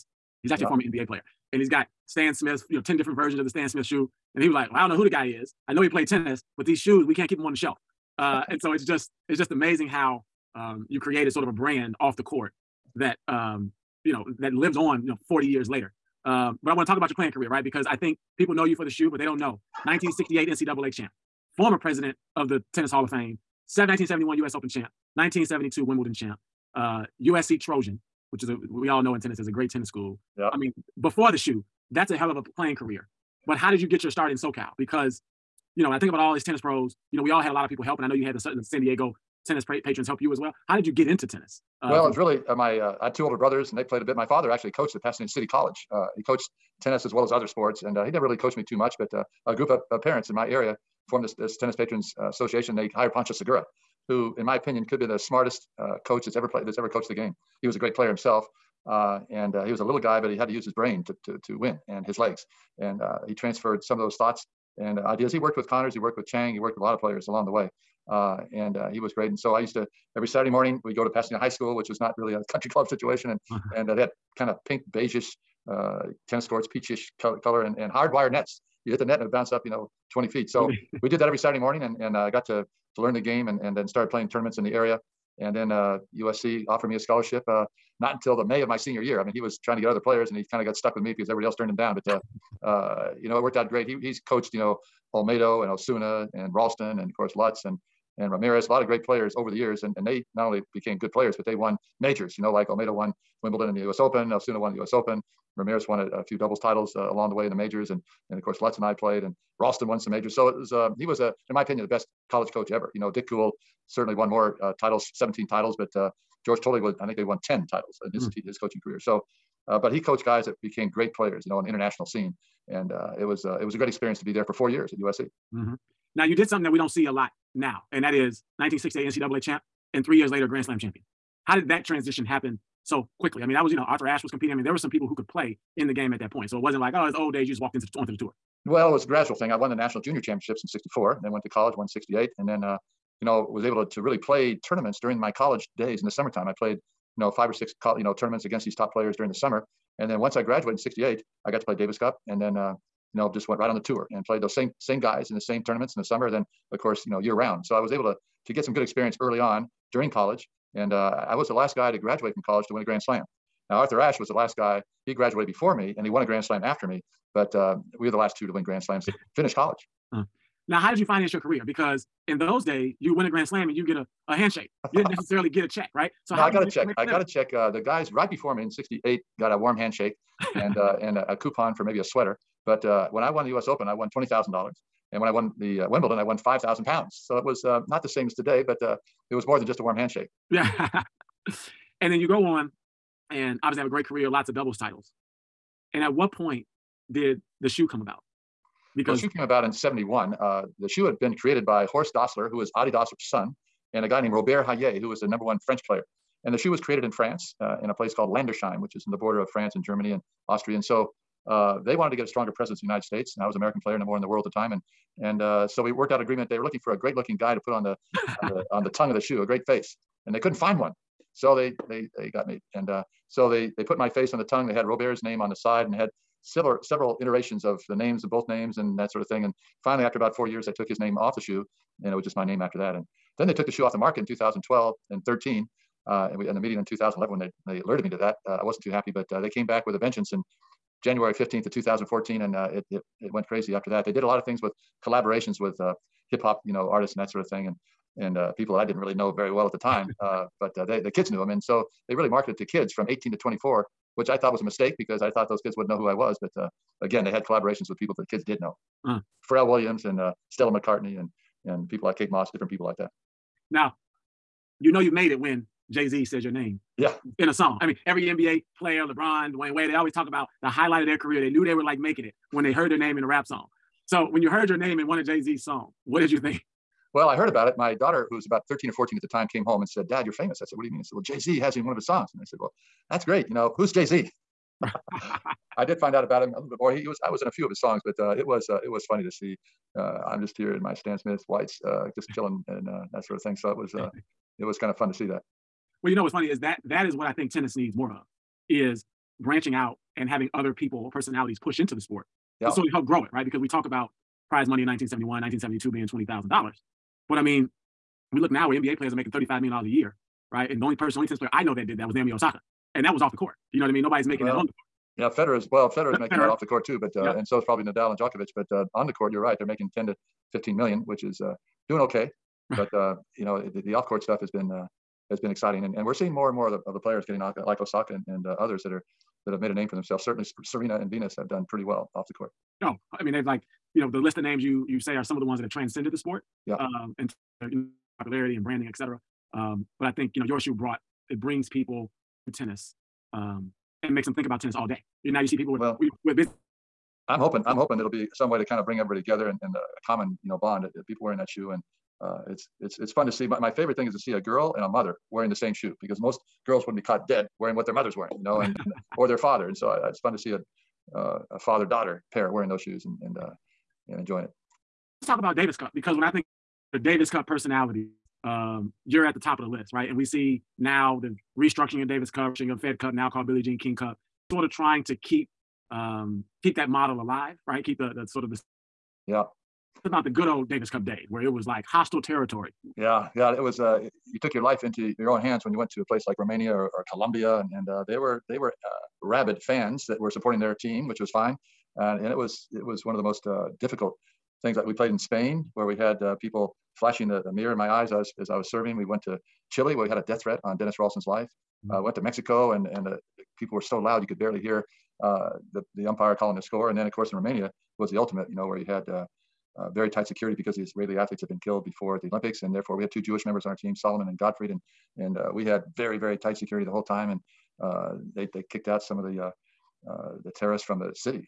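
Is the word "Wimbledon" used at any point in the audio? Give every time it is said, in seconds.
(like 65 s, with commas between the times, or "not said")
25 s, 103 s, 185 s.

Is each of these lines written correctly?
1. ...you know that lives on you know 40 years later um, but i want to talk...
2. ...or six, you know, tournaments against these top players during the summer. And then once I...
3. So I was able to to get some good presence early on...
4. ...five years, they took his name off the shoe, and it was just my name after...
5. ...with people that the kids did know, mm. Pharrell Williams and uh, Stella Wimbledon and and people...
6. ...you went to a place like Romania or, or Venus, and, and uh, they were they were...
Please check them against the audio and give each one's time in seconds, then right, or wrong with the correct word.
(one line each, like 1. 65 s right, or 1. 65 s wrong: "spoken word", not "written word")
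1. 14 s right
2. 147 s right
3. 157 s wrong: "experience", not "presence"
4. 230 s wrong: "four", not "five"
5. 257 s wrong: "McCartney", not "Wimbledon"
6. 385 s wrong: "Colombia", not "Venus".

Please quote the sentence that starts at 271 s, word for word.
They knew they were like making it when they heard their name in a rap song.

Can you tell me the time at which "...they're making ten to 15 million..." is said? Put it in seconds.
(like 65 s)
319 s.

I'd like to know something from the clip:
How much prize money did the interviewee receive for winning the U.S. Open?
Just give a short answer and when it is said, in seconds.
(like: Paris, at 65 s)
$20,000, at 184 s.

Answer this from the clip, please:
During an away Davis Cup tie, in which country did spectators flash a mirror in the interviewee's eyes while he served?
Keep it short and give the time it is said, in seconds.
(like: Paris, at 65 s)
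Spain, at 395 s.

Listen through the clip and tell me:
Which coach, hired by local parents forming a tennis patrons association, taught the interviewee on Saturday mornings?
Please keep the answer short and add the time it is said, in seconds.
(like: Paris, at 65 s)
Pancho Segura, at 53 s.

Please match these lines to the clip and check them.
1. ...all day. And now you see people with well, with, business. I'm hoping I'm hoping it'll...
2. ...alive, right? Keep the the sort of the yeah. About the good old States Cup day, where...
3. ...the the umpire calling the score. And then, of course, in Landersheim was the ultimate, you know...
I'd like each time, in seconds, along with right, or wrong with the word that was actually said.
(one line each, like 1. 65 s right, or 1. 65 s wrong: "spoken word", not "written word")
1. 344 s right
2. 377 s wrong: "Davis", not "States"
3. 405 s wrong: "Romania", not "Landersheim".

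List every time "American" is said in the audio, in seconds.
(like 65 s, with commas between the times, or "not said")
213 s.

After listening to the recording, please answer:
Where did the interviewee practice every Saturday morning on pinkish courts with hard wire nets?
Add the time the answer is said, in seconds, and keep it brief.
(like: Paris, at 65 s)
Pasadena High School, at 71 s.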